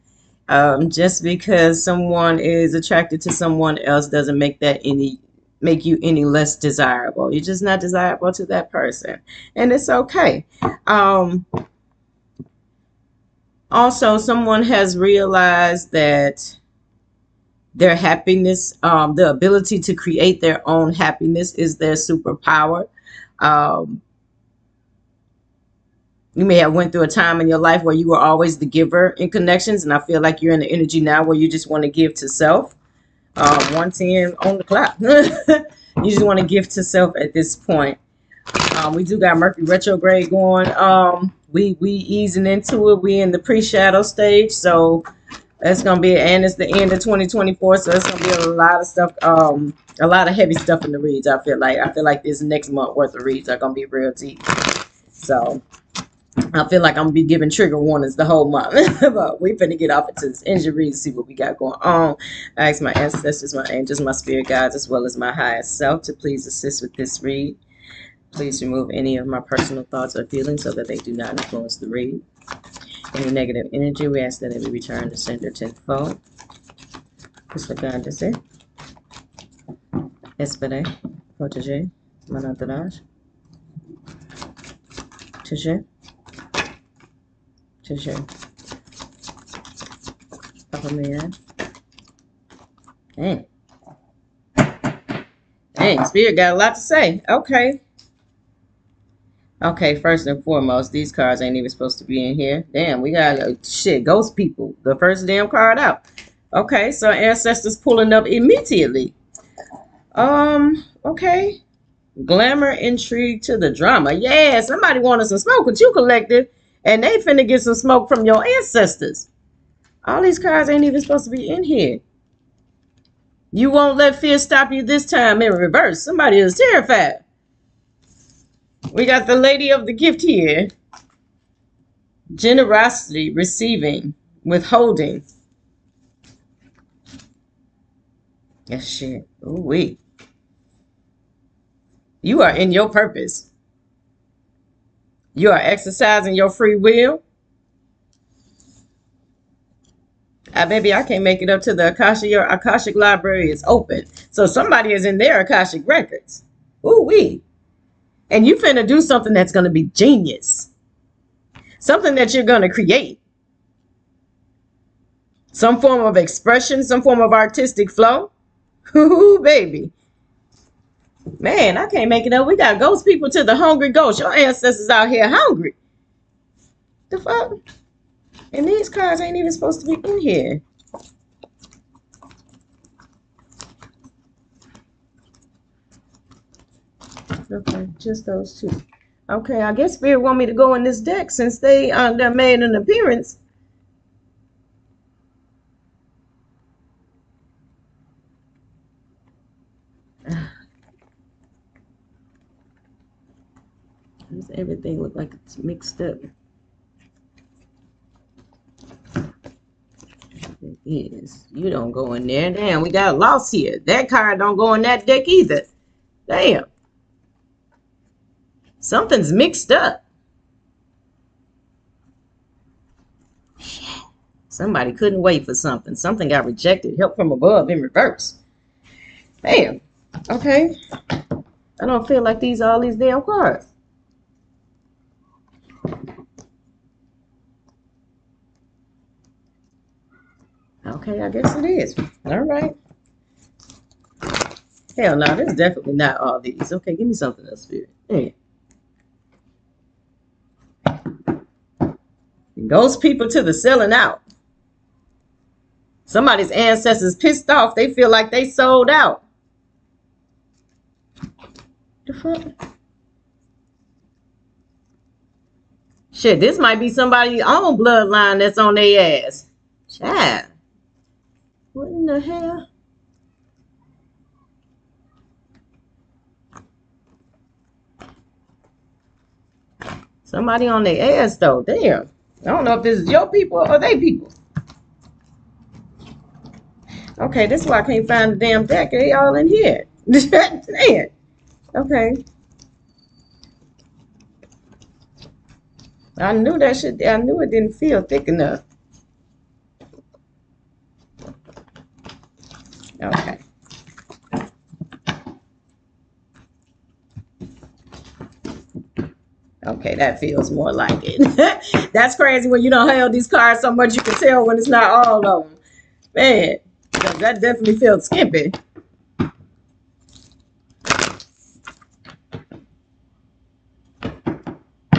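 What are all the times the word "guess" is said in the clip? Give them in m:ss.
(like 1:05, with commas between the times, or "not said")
3:09, 4:01.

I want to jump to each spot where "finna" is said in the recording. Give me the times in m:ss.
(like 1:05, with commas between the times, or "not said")
0:59, 1:57, 2:38.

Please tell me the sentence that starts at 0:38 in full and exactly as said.
Um, we do got Mercury retrograde going.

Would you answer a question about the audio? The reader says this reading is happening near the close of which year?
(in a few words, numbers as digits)
2024.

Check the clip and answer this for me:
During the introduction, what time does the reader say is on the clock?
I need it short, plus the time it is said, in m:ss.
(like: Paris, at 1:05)
110, at 0:33.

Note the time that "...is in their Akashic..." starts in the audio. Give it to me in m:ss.
2:34.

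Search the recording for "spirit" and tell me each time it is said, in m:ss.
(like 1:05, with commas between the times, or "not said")
1:04, 1:36, 3:09, 4:07.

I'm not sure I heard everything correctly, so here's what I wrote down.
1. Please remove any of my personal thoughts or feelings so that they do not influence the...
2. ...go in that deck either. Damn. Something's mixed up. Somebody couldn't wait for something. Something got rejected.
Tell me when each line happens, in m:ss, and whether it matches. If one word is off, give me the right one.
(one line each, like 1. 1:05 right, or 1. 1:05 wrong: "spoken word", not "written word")
1. 1:08 right
2. 3:34 right.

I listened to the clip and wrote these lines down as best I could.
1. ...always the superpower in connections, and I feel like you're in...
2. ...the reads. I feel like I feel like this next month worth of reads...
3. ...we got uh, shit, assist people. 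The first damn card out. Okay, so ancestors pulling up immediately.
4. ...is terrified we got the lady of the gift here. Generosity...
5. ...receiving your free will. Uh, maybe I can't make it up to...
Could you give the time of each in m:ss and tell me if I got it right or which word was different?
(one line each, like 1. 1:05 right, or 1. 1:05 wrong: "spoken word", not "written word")
1. 0:28 wrong: "giver", not "superpower"
2. 0:50 right
3. 1:42 wrong: "ghost", not "assist"
4. 2:06 right
5. 2:25 wrong: "exercising", not "receiving".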